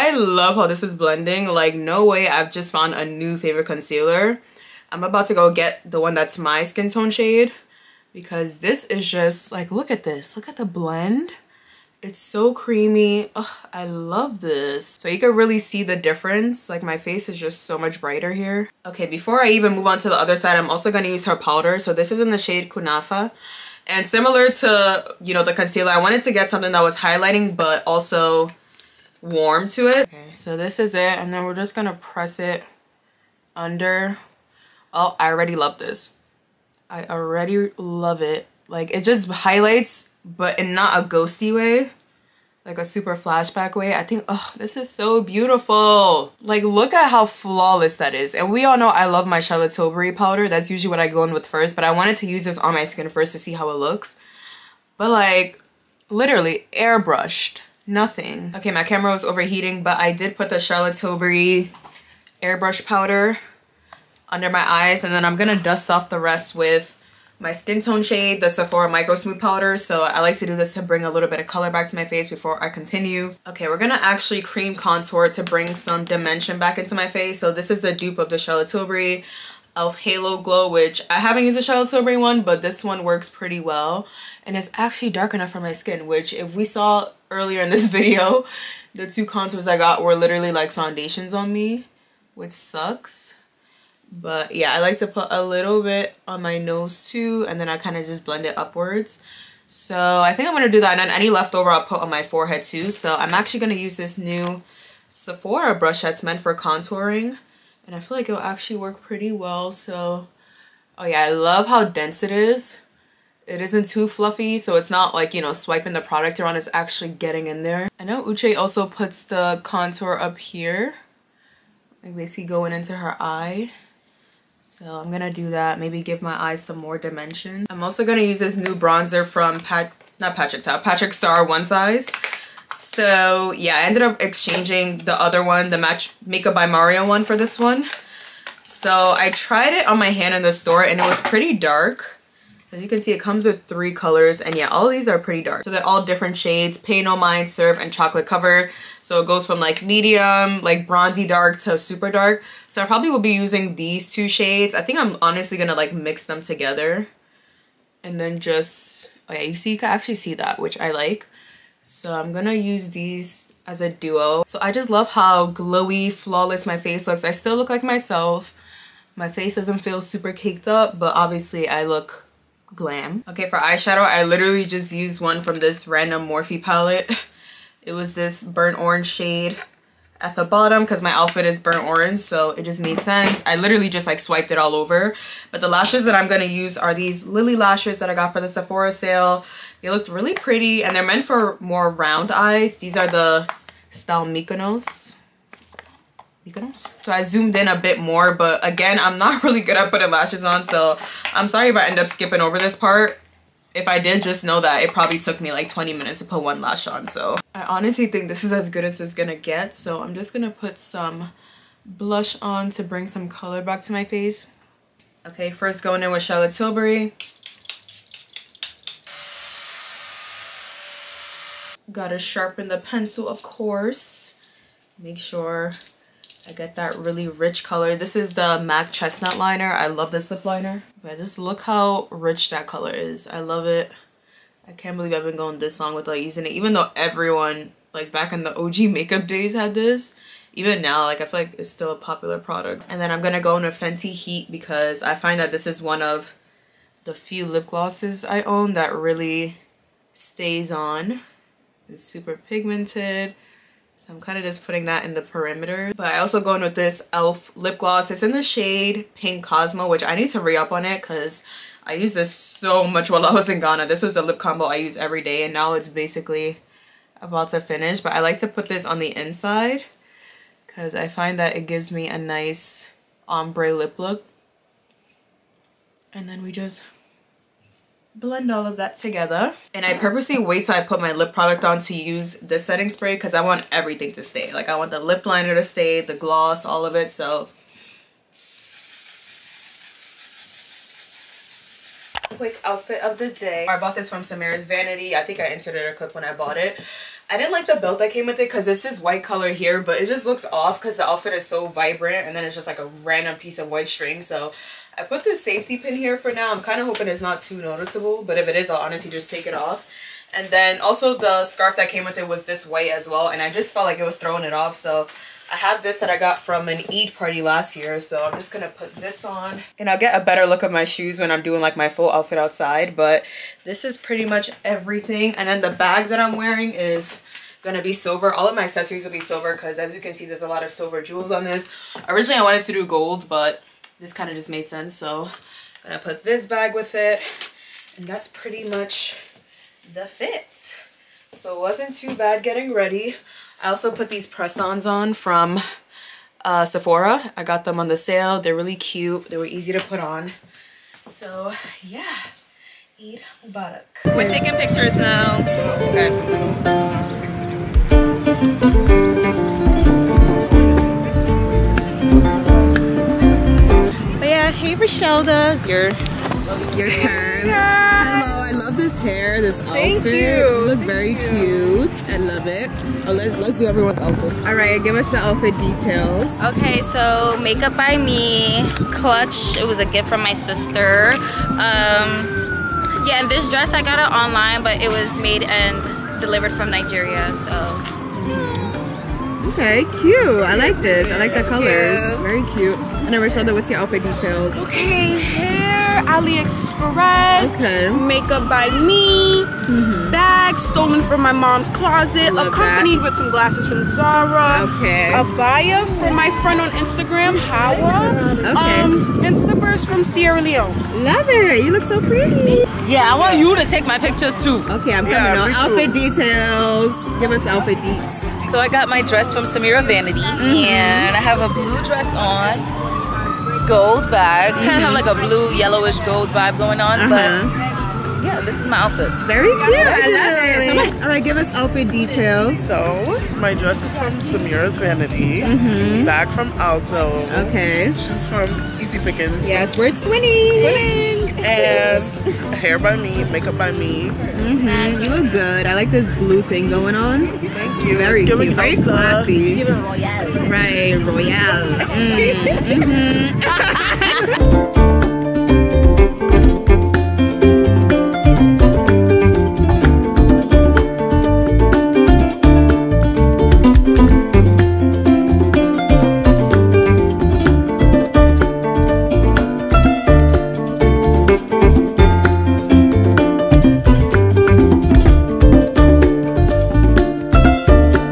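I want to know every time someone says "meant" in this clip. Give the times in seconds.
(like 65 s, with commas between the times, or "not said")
106 s, 191 s.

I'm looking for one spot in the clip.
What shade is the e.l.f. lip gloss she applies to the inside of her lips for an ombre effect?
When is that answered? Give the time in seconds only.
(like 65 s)
259 s.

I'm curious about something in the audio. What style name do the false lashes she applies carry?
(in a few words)
Mykonos.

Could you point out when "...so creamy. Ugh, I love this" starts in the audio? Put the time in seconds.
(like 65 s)
12 s.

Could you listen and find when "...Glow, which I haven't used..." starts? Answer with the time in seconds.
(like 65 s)
80 s.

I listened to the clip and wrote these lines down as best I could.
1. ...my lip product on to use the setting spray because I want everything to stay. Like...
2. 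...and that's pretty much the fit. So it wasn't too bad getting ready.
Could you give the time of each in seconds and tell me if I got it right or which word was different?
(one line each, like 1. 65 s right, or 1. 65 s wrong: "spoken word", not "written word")
1. 281 s right
2. 337 s right.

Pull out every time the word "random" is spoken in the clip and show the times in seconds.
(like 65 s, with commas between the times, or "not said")
175 s, 303 s.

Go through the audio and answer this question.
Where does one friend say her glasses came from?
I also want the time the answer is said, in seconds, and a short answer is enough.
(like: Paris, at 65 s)
Zara, at 403 s.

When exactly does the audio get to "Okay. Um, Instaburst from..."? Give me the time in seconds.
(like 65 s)
408 s.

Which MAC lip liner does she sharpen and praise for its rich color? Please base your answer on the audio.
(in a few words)
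Chestnut.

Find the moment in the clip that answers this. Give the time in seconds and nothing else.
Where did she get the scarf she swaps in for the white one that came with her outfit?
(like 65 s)
316 s.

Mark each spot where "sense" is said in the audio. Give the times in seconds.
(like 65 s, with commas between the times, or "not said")
183 s, 334 s.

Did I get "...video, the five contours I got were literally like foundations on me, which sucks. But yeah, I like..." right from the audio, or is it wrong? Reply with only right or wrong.
wrong.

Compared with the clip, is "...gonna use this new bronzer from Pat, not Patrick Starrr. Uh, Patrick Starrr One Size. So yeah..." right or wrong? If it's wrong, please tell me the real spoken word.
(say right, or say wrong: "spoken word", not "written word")
right.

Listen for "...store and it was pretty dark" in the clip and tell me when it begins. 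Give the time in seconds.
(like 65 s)
140 s.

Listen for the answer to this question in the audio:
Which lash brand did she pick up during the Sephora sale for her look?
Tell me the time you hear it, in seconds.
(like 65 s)
187 s.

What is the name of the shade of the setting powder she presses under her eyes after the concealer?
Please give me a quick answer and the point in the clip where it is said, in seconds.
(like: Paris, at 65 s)
Kunafa, at 22 s.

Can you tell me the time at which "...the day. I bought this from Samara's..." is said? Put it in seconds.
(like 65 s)
293 s.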